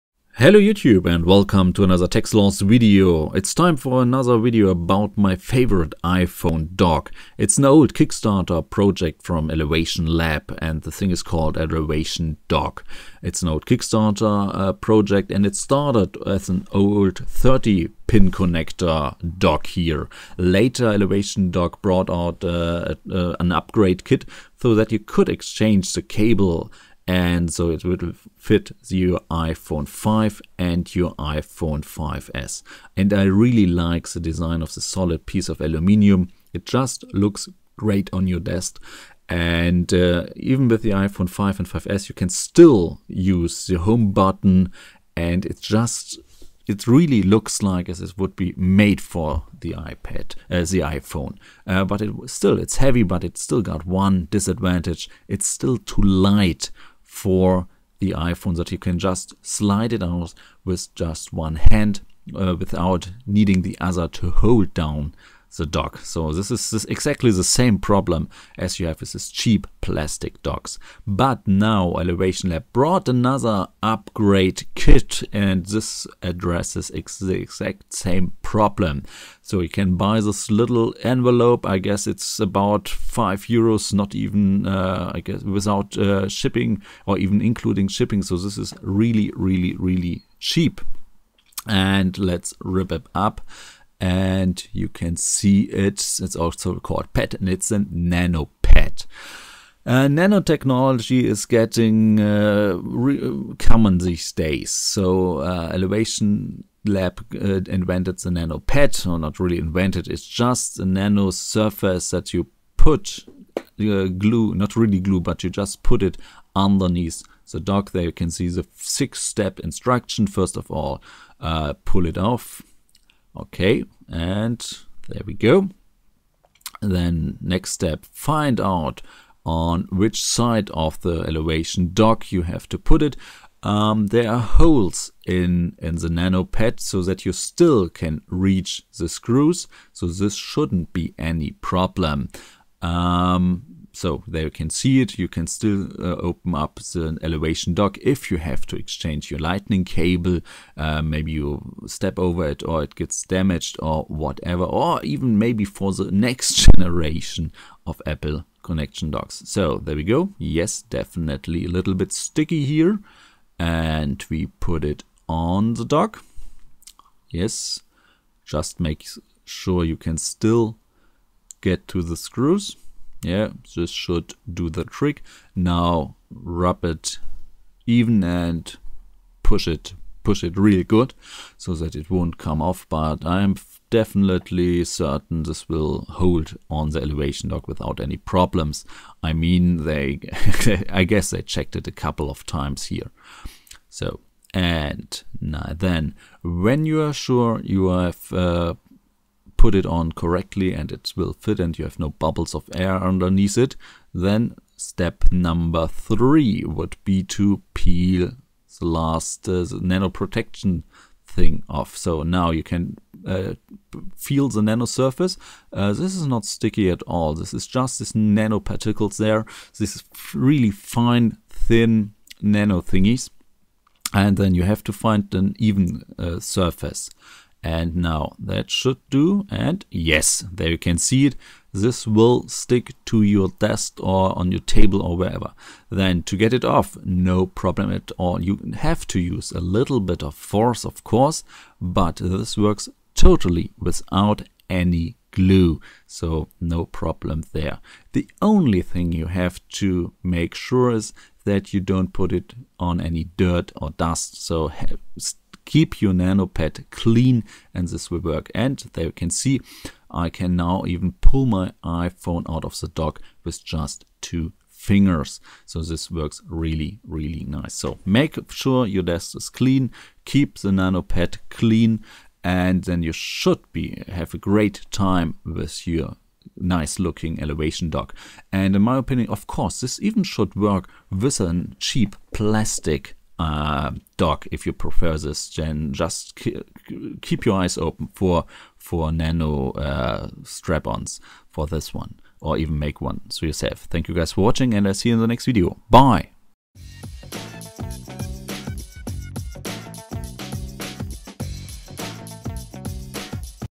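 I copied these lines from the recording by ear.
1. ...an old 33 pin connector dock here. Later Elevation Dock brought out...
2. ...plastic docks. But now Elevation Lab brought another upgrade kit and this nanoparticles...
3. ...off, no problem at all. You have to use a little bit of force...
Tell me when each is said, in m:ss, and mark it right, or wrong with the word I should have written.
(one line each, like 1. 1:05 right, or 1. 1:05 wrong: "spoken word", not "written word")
1. 0:16 wrong: "30", not "33"
2. 1:09 wrong: "addresses", not "nanoparticles"
3. 3:56 right.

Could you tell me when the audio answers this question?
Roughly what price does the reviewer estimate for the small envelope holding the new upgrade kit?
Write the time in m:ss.
1:22.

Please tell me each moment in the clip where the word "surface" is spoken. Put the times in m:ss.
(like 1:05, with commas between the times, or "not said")
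1:51, 3:34, 3:46.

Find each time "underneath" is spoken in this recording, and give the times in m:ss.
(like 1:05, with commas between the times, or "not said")
1:56, 3:22.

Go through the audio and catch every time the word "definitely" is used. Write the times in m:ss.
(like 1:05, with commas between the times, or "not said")
2:40, 3:03.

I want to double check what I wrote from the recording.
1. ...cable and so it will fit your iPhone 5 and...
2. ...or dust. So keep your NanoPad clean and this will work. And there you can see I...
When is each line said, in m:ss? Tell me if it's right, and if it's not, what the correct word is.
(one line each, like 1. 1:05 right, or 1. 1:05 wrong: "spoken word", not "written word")
1. 0:26 right
2. 4:13 right.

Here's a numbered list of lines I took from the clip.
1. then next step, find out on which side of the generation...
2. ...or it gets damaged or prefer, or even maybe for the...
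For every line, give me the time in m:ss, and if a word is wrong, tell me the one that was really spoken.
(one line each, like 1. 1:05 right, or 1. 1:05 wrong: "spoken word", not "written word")
1. 2:06 wrong: "elevation", not "generation"
2. 2:32 wrong: "whatever", not "prefer".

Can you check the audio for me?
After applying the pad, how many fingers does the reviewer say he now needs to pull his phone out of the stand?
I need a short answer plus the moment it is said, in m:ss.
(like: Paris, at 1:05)
2, at 4:24.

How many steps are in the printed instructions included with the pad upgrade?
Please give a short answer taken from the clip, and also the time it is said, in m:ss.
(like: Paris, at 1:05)
6, at 1:58.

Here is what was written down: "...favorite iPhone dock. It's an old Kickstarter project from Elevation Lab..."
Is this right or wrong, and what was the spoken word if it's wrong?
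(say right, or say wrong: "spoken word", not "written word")
right.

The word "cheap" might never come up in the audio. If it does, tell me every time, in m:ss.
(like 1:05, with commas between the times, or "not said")
1:09, 1:30, 4:41.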